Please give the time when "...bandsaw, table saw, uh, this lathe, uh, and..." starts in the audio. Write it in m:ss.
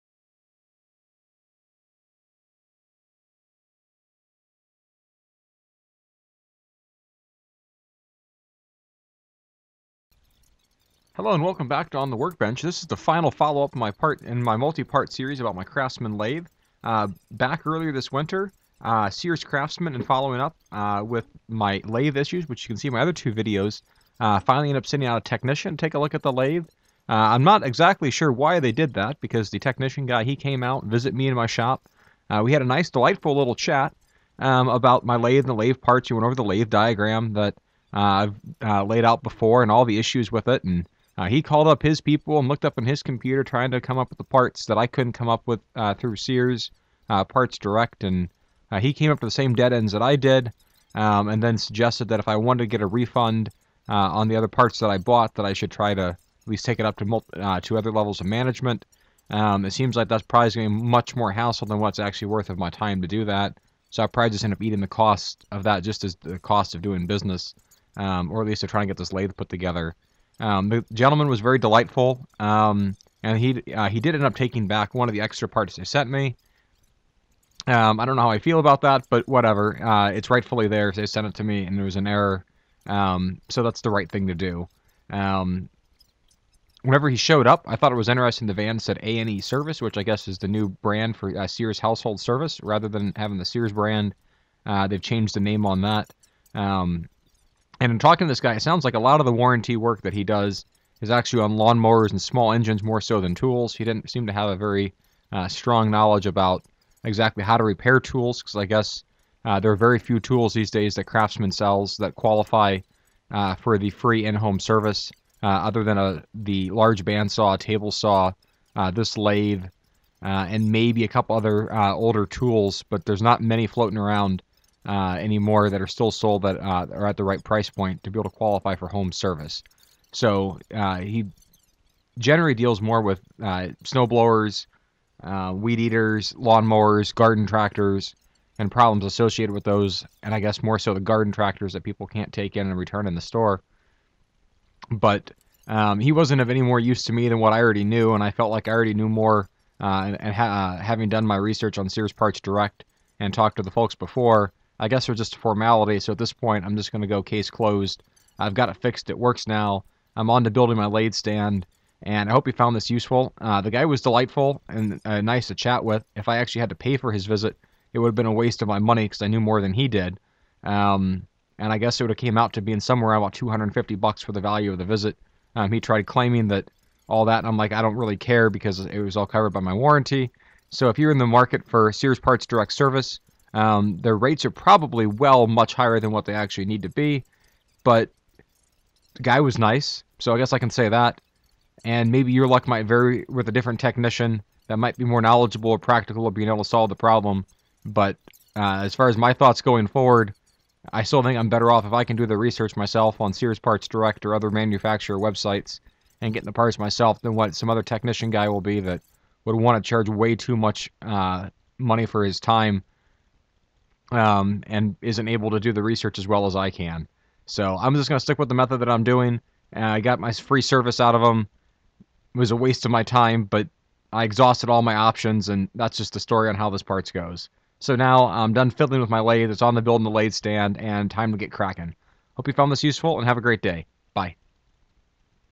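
1:57.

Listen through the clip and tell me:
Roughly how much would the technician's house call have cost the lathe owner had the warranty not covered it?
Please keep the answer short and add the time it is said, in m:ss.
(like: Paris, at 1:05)
$250, at 2:53.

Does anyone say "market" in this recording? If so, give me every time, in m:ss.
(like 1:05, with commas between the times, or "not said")
3:01.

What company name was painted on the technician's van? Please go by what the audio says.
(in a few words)
A and E Service.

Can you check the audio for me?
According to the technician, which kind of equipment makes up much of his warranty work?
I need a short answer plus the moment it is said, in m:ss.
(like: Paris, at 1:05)
lawnmowers and small engines, at 1:41.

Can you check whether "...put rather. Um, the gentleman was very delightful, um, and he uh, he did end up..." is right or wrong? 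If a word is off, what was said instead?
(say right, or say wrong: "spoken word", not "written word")
wrong: "together", not "rather".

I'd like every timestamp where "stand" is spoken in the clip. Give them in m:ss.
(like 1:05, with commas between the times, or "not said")
2:41, 3:50.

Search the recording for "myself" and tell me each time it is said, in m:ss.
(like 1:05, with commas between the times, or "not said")
3:22, 3:26.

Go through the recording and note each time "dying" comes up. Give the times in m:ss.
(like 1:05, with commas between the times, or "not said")
not said.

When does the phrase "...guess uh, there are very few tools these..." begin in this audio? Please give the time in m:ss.
1:48.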